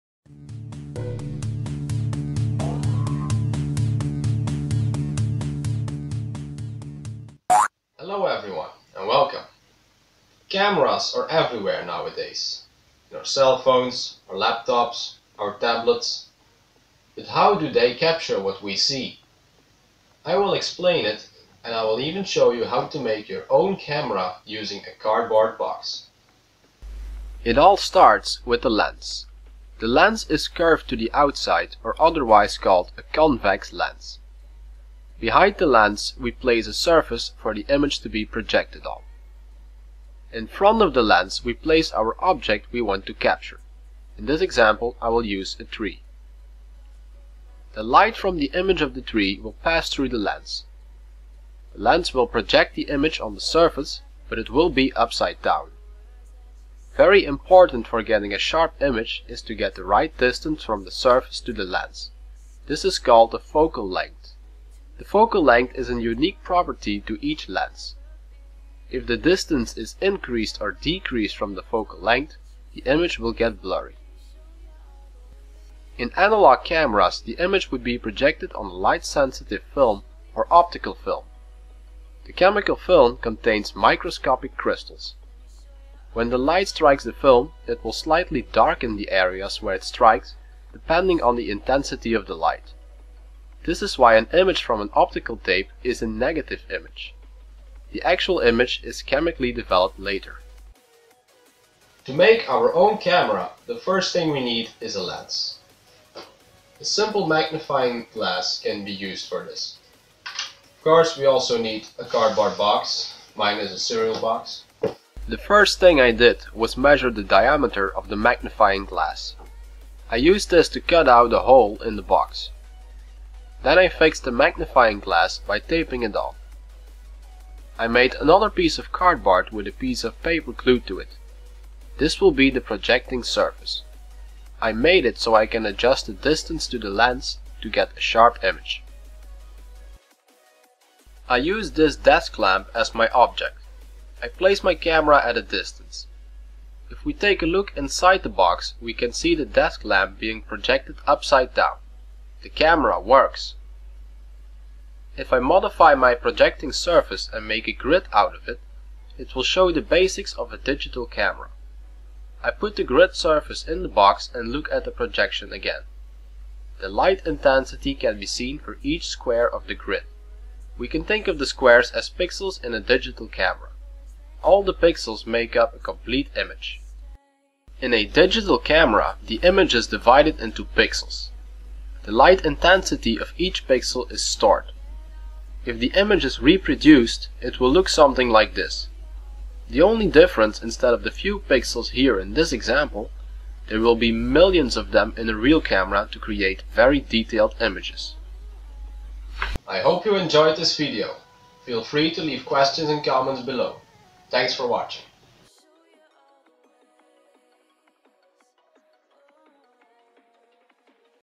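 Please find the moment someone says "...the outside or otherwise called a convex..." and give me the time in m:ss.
0:30.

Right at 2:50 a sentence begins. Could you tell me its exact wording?
We can think of the squares as pixels in a digital camera.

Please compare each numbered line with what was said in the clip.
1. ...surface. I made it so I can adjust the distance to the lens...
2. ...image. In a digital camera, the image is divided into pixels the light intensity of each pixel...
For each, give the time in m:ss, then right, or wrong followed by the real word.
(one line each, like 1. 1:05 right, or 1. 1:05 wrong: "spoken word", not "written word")
1. 2:13 right
2. 2:56 right.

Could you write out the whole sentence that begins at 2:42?
I put the grid surface in the box and look at the projection again.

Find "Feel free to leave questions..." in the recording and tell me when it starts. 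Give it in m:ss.
3:21.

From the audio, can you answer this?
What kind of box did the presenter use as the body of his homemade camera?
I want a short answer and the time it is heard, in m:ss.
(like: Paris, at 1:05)
cereal box, at 1:53.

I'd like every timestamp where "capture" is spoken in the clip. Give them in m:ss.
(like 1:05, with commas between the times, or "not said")
0:17, 0:43.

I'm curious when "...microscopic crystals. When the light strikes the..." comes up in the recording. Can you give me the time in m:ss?
1:23.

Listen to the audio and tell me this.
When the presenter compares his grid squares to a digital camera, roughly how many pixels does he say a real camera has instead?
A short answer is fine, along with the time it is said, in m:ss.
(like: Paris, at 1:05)
millions, at 3:14.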